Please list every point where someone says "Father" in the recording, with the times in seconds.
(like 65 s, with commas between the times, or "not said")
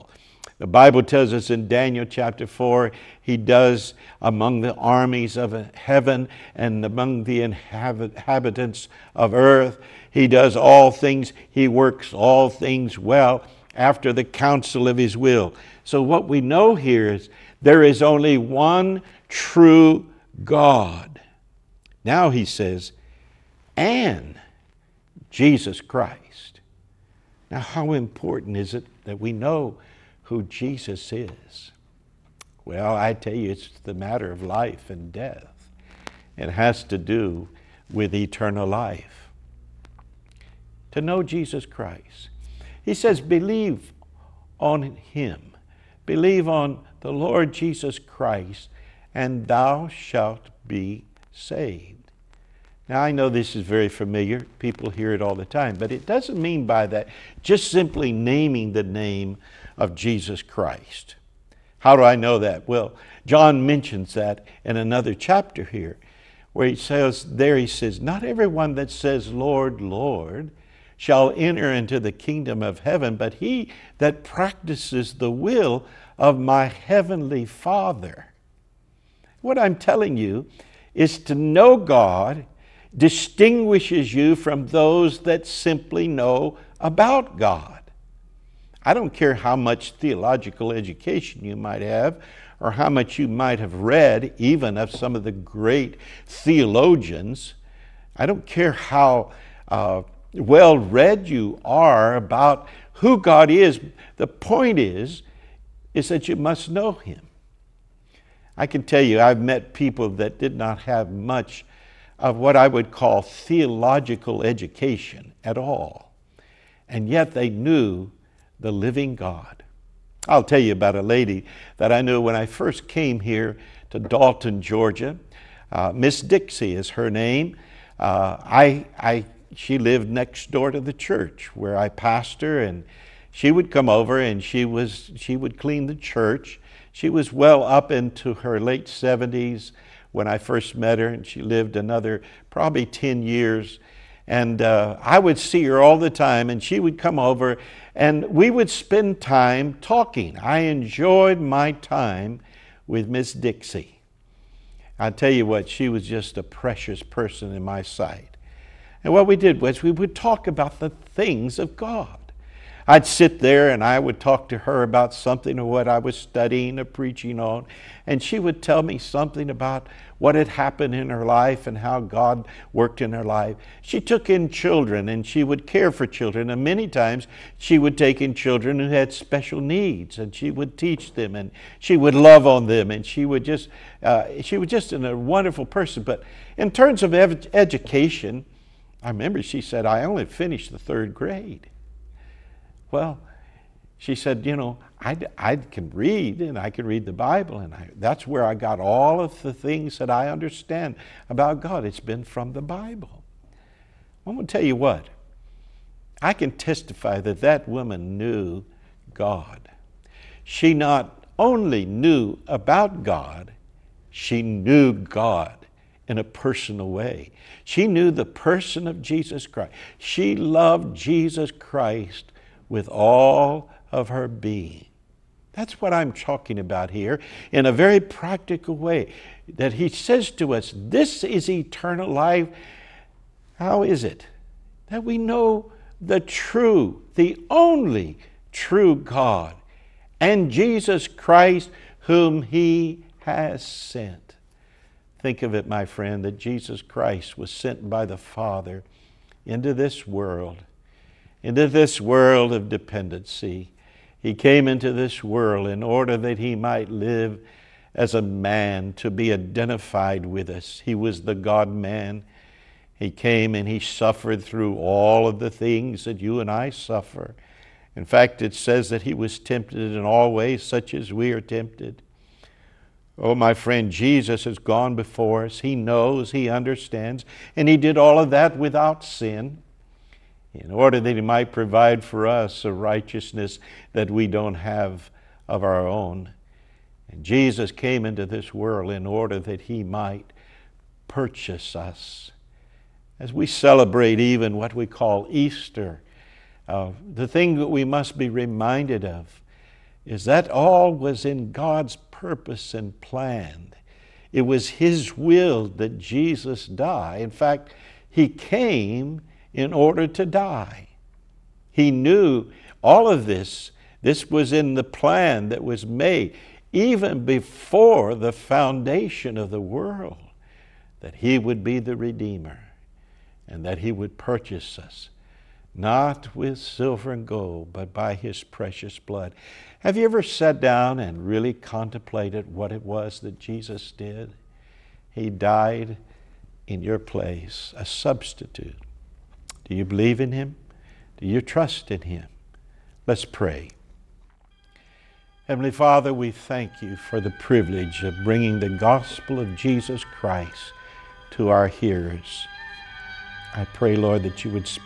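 77 s, 248 s, 345 s.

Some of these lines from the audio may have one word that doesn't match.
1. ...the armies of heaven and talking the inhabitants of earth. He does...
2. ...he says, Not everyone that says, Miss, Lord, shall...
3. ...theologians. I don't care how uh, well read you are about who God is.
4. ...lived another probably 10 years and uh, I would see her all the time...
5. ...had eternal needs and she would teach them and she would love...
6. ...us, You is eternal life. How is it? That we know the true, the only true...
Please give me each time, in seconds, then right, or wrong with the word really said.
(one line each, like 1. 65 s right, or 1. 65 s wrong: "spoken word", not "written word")
1. 4 s wrong: "among", not "talking"
2. 67 s wrong: "Lord", not "Miss"
3. 96 s right
4. 141 s right
5. 178 s wrong: "special", not "eternal"
6. 230 s wrong: "This", not "You".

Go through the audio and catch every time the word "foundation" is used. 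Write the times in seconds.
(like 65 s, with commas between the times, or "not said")
318 s.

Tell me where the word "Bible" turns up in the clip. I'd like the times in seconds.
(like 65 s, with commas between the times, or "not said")
0 s, 197 s, 202 s.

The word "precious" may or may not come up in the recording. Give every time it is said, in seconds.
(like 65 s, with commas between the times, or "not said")
156 s, 328 s.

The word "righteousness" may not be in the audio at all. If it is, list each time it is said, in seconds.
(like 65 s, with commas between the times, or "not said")
282 s.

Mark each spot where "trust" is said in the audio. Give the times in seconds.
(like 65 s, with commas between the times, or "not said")
341 s.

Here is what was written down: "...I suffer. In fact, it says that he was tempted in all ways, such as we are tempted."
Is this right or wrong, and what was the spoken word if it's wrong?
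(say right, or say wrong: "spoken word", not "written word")
right.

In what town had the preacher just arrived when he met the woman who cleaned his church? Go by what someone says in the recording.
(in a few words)
Dalton, Georgia.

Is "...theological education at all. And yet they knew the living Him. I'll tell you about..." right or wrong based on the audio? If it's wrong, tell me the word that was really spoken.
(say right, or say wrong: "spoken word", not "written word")
wrong: "God", not "Him".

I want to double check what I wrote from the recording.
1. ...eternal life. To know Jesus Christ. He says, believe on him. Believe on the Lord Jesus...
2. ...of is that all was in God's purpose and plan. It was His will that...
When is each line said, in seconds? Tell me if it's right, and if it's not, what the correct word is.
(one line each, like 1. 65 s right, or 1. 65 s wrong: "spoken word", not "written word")
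1. 38 s right
2. 299 s right.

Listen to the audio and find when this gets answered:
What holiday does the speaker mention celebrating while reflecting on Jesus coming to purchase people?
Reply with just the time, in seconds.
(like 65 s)
295 s.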